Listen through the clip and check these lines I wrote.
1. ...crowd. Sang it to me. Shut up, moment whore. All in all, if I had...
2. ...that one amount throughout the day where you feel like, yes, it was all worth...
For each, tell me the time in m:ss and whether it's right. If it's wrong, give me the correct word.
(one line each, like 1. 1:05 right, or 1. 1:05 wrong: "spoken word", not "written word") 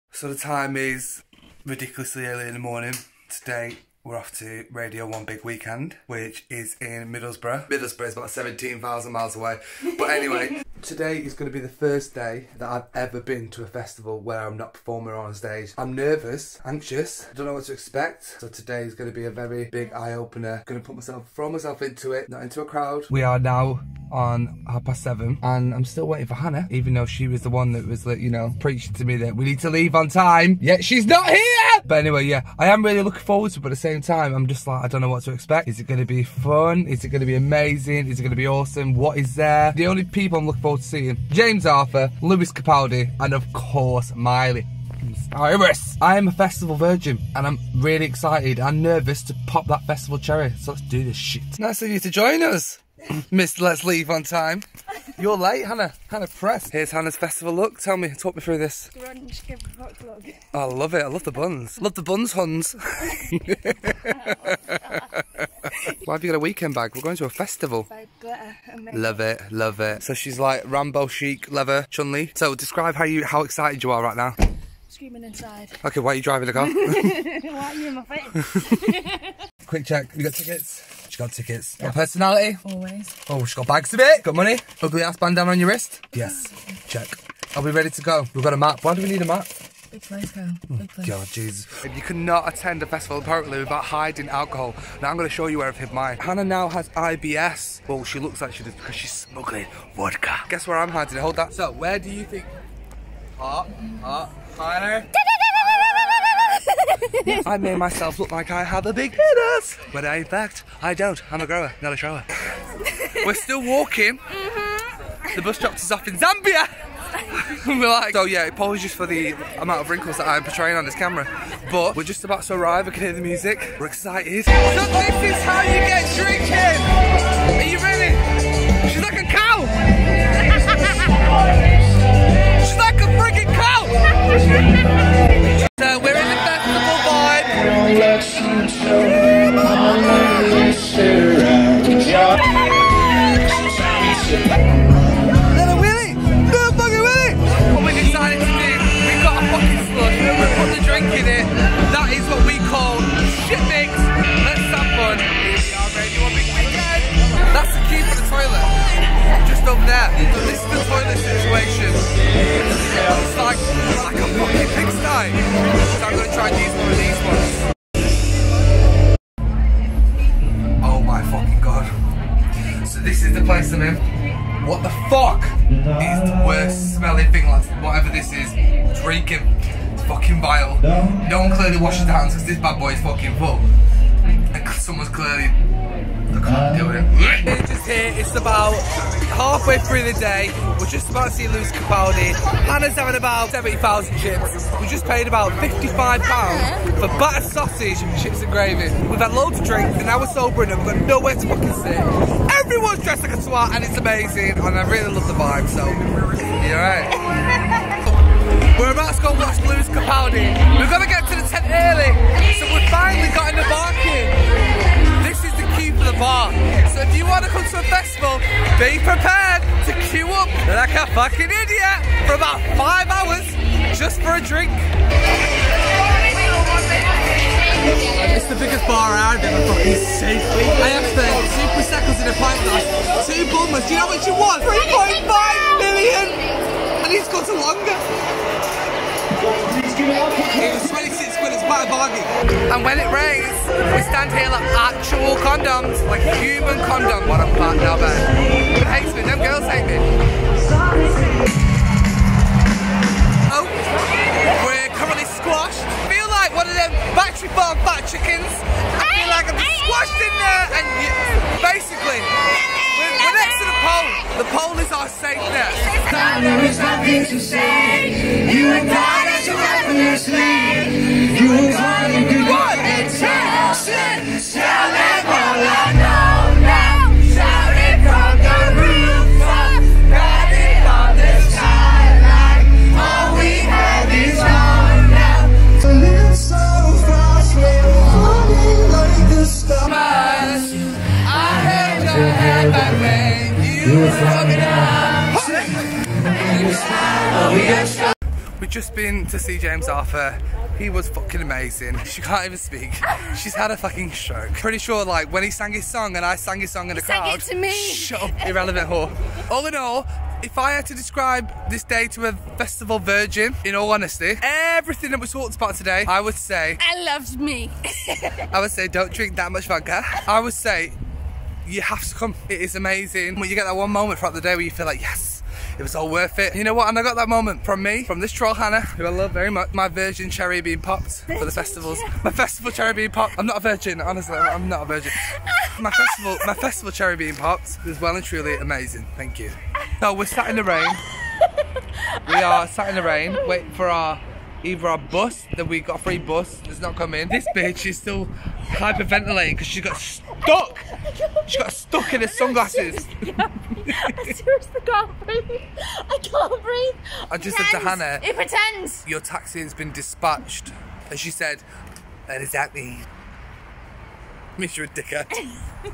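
1. 5:07 wrong: "irrelevant", not "moment"
2. 5:23 wrong: "moment", not "amount".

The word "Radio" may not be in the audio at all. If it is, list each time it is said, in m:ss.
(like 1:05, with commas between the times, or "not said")
0:04.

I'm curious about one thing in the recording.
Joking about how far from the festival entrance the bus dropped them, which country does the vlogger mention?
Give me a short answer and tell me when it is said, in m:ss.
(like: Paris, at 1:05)
Zambia, at 1:56.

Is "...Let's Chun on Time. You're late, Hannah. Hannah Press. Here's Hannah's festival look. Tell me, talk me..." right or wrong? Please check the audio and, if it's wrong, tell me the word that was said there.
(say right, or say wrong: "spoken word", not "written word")
wrong: "Leave", not "Chun".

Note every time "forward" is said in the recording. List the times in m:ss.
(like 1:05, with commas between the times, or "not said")
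0:33, 0:40.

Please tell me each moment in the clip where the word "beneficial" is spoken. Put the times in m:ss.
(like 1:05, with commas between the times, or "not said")
not said.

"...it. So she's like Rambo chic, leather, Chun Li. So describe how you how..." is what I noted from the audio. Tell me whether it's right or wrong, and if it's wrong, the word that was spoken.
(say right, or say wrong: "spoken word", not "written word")
right.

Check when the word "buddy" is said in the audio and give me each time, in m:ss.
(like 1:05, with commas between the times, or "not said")
not said.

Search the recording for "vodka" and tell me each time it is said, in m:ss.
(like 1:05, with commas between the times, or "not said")
1:39, 5:19.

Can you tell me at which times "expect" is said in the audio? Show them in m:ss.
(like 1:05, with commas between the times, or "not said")
0:17, 0:35.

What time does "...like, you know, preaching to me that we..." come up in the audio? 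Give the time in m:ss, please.
0:28.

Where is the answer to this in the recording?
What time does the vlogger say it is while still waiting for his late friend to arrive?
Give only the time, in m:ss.
0:24.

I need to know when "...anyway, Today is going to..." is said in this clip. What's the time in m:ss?
0:10.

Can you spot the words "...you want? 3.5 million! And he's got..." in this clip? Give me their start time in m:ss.
3:54.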